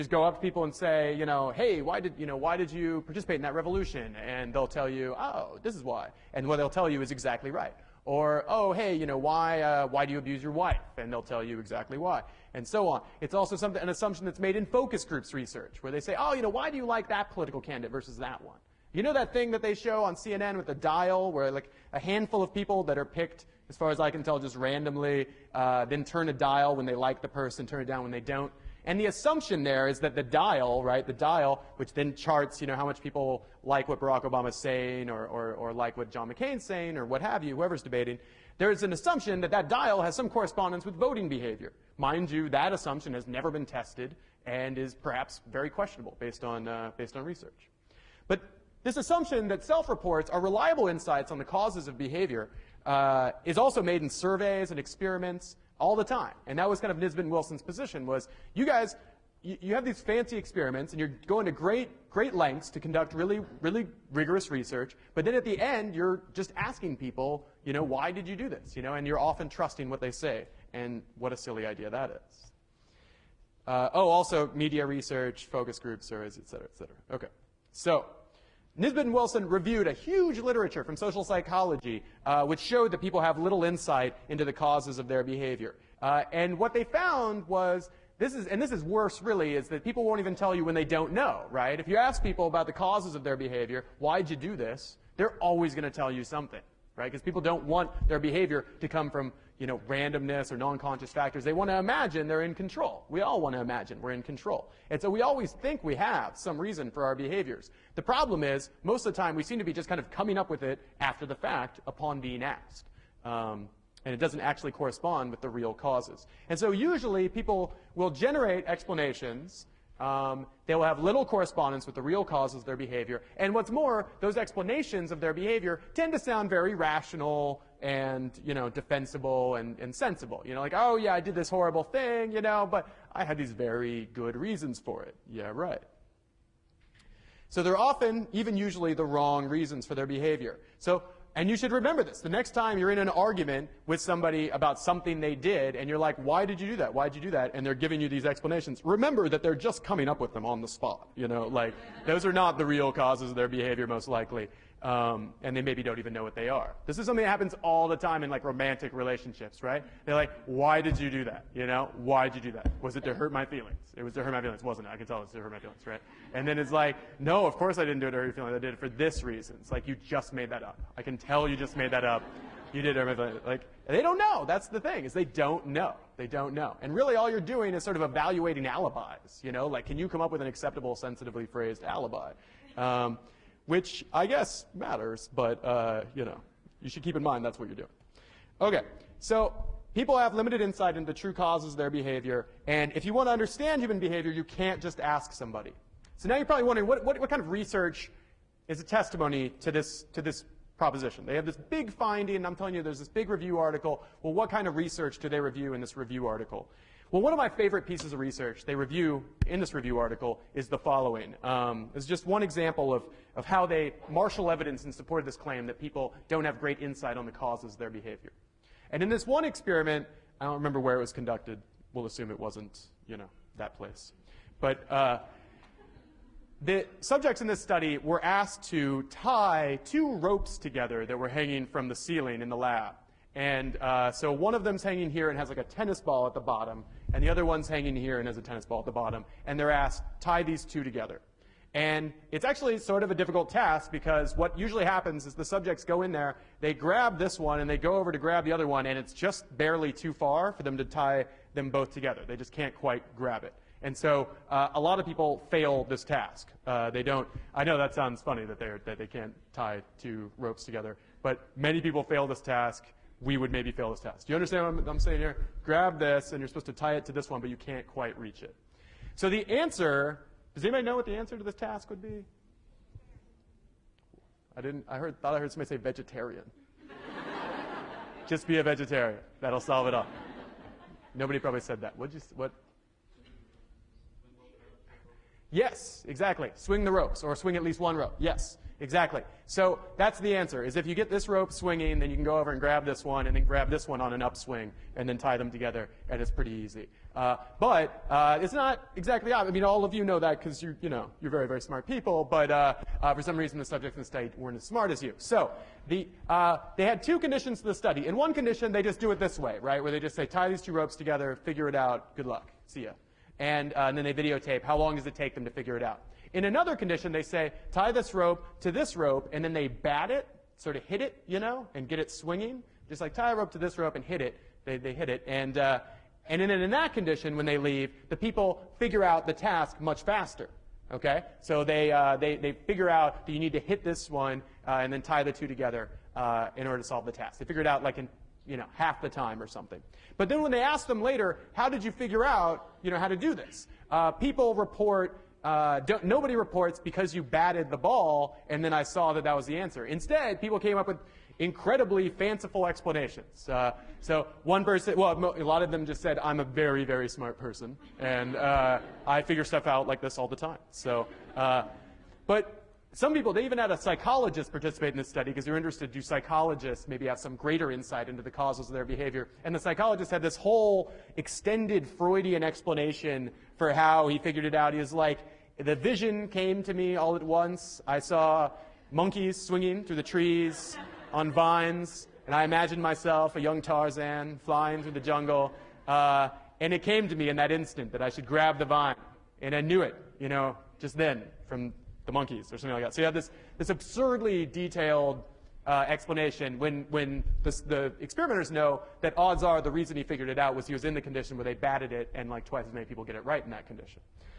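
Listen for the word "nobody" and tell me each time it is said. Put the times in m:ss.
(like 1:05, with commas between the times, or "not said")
4:41, 5:46.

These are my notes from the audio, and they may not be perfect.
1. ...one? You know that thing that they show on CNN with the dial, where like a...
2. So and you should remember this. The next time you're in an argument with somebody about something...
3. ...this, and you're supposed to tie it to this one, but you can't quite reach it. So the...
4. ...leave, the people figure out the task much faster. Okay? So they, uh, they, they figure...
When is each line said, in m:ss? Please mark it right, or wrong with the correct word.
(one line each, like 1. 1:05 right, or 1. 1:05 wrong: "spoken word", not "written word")
1. 0:18 right
2. 2:20 right
3. 4:25 right
4. 5:27 right.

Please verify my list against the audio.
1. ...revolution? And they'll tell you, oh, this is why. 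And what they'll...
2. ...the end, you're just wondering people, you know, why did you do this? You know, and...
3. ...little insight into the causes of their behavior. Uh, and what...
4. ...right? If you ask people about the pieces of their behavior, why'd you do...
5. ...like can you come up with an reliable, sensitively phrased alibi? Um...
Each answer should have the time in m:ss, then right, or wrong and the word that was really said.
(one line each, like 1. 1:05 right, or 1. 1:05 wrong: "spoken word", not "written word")
1. 0:03 right
2. 1:05 wrong: "asking", not "wondering"
3. 1:23 right
4. 1:31 wrong: "causes", not "pieces"
5. 2:59 wrong: "acceptable", not "reliable".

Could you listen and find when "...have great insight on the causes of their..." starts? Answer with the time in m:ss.
3:36.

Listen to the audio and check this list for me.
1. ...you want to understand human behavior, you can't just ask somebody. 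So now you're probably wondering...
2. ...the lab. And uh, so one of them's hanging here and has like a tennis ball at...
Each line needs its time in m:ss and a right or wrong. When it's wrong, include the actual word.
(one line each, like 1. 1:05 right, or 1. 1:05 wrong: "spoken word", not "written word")
1. 3:13 right
2. 3:52 right.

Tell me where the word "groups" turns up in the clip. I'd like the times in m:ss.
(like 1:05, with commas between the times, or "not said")
0:15, 1:15.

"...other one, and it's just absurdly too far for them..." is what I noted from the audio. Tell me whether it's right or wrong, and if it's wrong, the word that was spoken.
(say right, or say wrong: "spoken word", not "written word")
wrong: "barely", not "absurdly".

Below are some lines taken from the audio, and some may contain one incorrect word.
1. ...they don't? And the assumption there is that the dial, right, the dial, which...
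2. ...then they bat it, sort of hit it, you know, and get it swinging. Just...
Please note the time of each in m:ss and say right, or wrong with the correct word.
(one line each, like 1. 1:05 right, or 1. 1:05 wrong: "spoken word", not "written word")
1. 0:28 right
2. 5:19 right.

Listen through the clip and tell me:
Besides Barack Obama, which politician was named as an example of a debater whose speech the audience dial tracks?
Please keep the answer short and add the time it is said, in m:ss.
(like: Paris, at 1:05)
John McCain, at 0:36.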